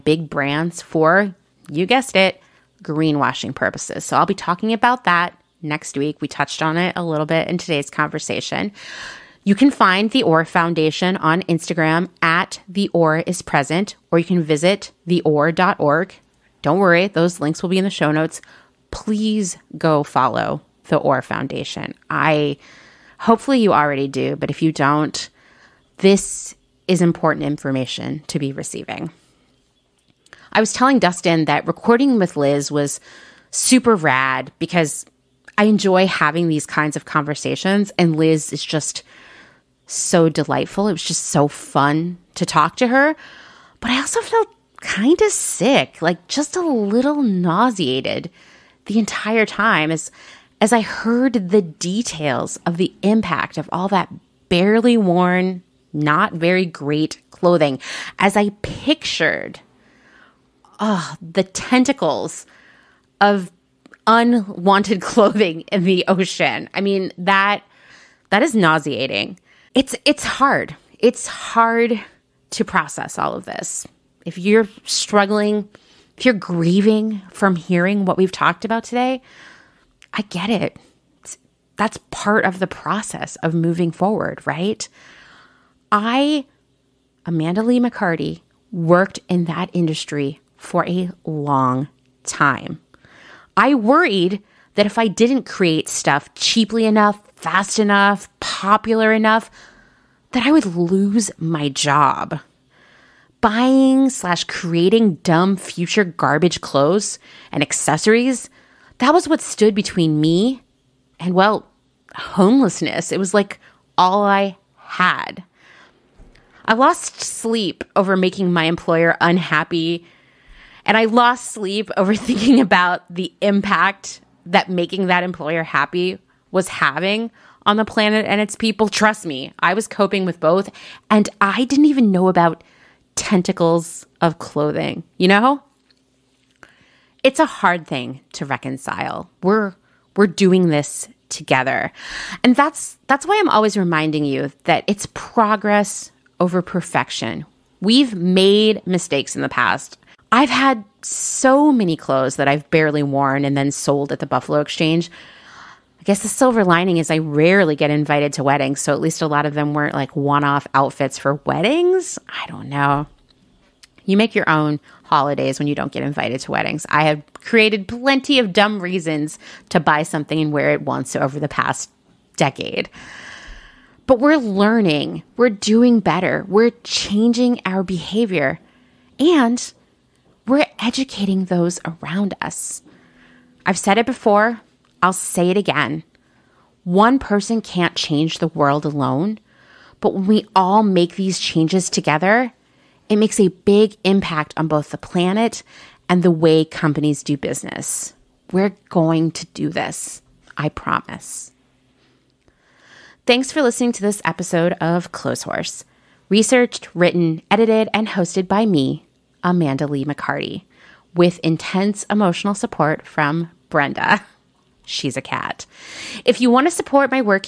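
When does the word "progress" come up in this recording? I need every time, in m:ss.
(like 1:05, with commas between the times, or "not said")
2:25.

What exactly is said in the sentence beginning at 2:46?
I have created plenty of dumb reasons to buy something and wear it once over the past decade.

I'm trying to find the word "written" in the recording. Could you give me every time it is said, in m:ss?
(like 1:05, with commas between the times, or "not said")
3:26.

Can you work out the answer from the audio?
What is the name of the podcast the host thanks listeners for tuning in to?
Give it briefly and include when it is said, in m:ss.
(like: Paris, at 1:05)
Clotheshorse, at 3:25.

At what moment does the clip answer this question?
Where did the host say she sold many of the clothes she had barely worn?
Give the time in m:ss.
2:34.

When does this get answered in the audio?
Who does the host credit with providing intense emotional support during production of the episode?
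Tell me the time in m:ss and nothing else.
3:33.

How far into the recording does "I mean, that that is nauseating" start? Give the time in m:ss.
1:06.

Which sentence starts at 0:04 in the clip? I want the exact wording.
So I'll be talking about that next week.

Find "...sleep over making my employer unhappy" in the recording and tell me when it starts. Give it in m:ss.
1:57.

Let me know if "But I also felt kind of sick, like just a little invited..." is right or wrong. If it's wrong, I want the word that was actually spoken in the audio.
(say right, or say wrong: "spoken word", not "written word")
wrong: "nauseated", not "invited".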